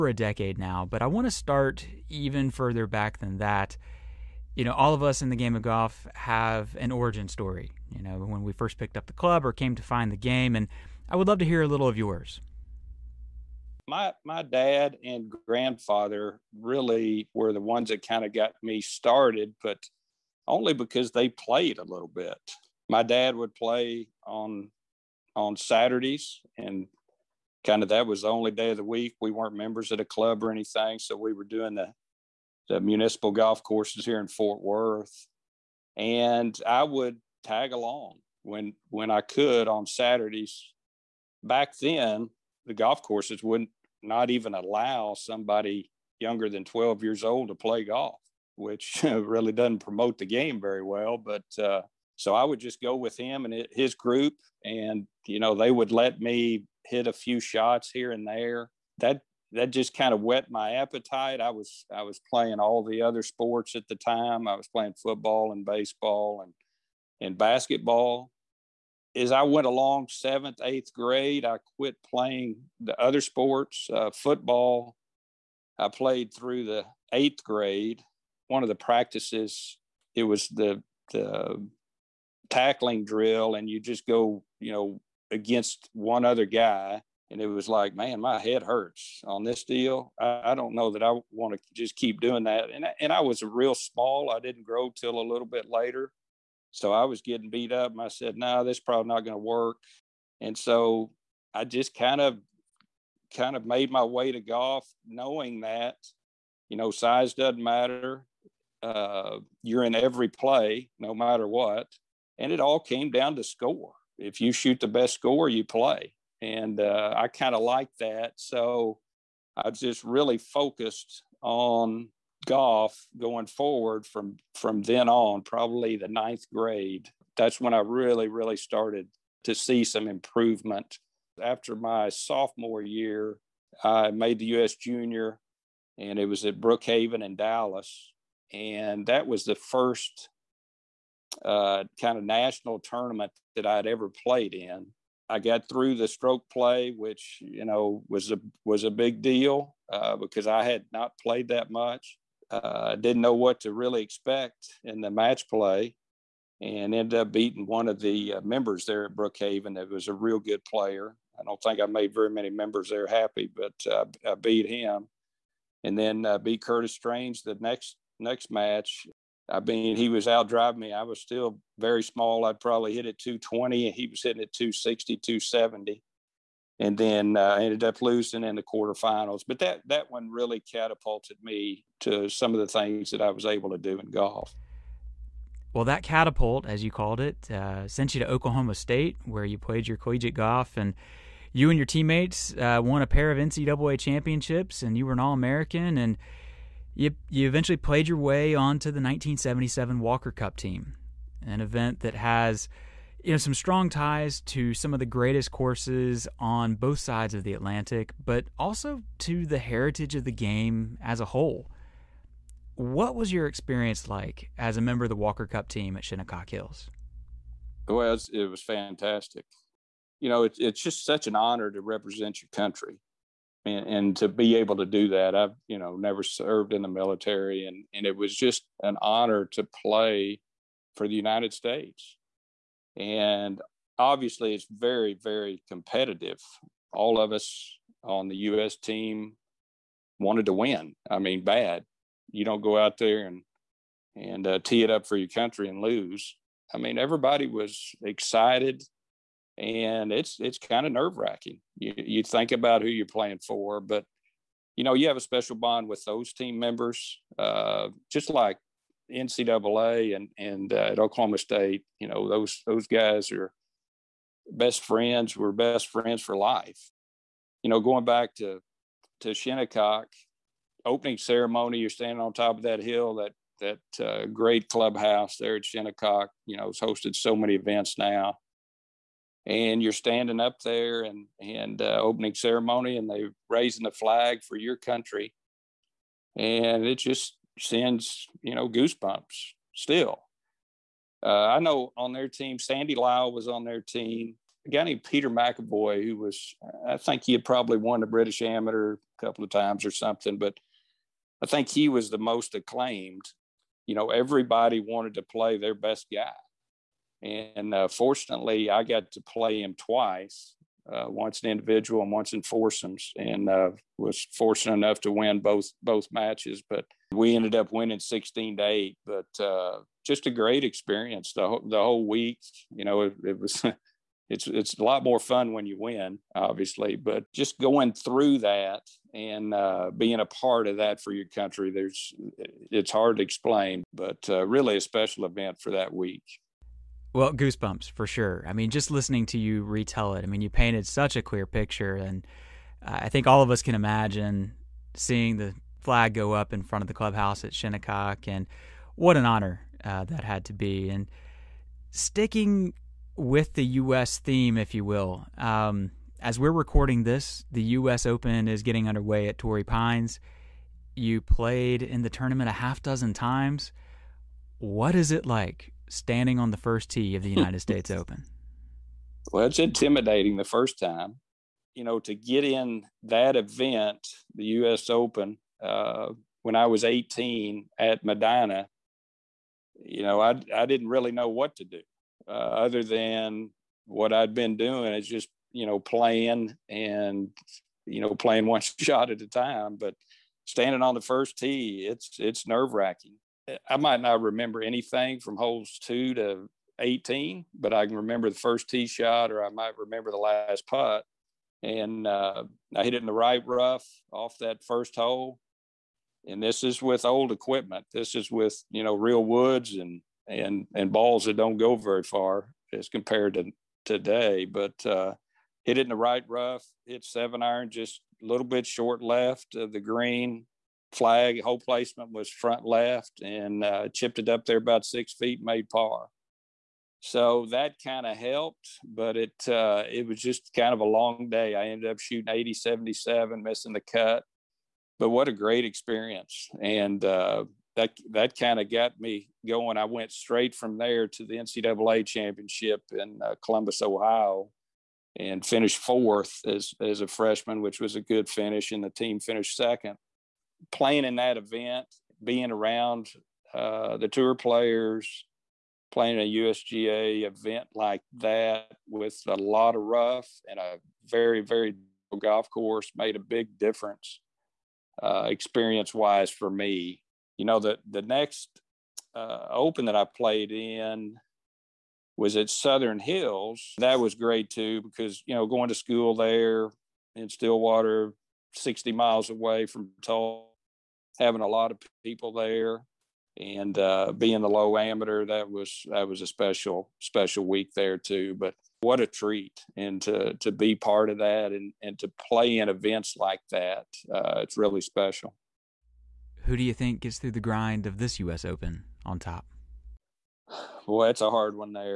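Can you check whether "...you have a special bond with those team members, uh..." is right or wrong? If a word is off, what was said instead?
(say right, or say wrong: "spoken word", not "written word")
right.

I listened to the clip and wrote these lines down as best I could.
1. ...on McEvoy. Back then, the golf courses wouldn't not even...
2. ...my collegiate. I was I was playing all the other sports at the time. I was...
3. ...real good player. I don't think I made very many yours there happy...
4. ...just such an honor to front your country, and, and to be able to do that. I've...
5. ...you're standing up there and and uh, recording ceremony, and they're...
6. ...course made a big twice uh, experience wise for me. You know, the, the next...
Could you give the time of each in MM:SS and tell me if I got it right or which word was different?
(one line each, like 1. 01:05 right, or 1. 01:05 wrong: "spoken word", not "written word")
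1. 00:39 wrong: "Saturdays", not "McEvoy"
2. 01:00 wrong: "appetite", not "collegiate"
3. 02:40 wrong: "members", not "yours"
4. 03:40 wrong: "represent", not "front"
5. 04:39 wrong: "opening", not "recording"
6. 07:42 wrong: "difference", not "twice".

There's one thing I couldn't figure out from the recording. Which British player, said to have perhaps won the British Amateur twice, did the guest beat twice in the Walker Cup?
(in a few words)
Peter McEvoy.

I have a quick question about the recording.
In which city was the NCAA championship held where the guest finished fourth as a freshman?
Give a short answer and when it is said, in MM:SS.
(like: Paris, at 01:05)
Columbus, Ohio, at 07:23.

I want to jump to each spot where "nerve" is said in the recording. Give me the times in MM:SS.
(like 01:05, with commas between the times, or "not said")
04:10, 06:32.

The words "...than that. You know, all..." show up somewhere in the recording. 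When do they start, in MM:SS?
00:03.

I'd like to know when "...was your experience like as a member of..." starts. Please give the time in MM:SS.
03:33.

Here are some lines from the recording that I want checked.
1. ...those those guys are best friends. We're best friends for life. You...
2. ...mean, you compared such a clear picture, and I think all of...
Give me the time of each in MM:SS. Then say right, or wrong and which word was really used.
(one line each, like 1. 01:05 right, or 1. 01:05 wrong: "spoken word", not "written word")
1. 04:22 right
2. 05:40 wrong: "painted", not "compared".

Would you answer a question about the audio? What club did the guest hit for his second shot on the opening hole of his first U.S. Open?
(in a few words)
7 iron.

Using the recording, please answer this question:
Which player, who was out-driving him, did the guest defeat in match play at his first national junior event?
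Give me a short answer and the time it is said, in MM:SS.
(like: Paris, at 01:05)
Curtis Strange, at 02:46.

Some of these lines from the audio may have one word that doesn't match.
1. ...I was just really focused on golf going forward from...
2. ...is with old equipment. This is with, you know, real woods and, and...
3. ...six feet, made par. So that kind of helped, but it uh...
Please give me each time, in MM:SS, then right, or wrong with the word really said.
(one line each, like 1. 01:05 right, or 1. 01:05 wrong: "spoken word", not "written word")
1. 01:59 right
2. 06:46 right
3. 07:04 right.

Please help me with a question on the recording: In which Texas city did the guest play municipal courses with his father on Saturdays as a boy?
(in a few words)
Fort Worth.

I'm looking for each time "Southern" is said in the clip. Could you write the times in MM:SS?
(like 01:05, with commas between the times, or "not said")
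07:52.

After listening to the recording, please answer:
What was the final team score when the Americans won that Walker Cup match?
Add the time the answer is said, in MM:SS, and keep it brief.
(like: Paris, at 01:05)
16 to 8, at 05:18.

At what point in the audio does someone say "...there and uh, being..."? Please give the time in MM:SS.
08:02.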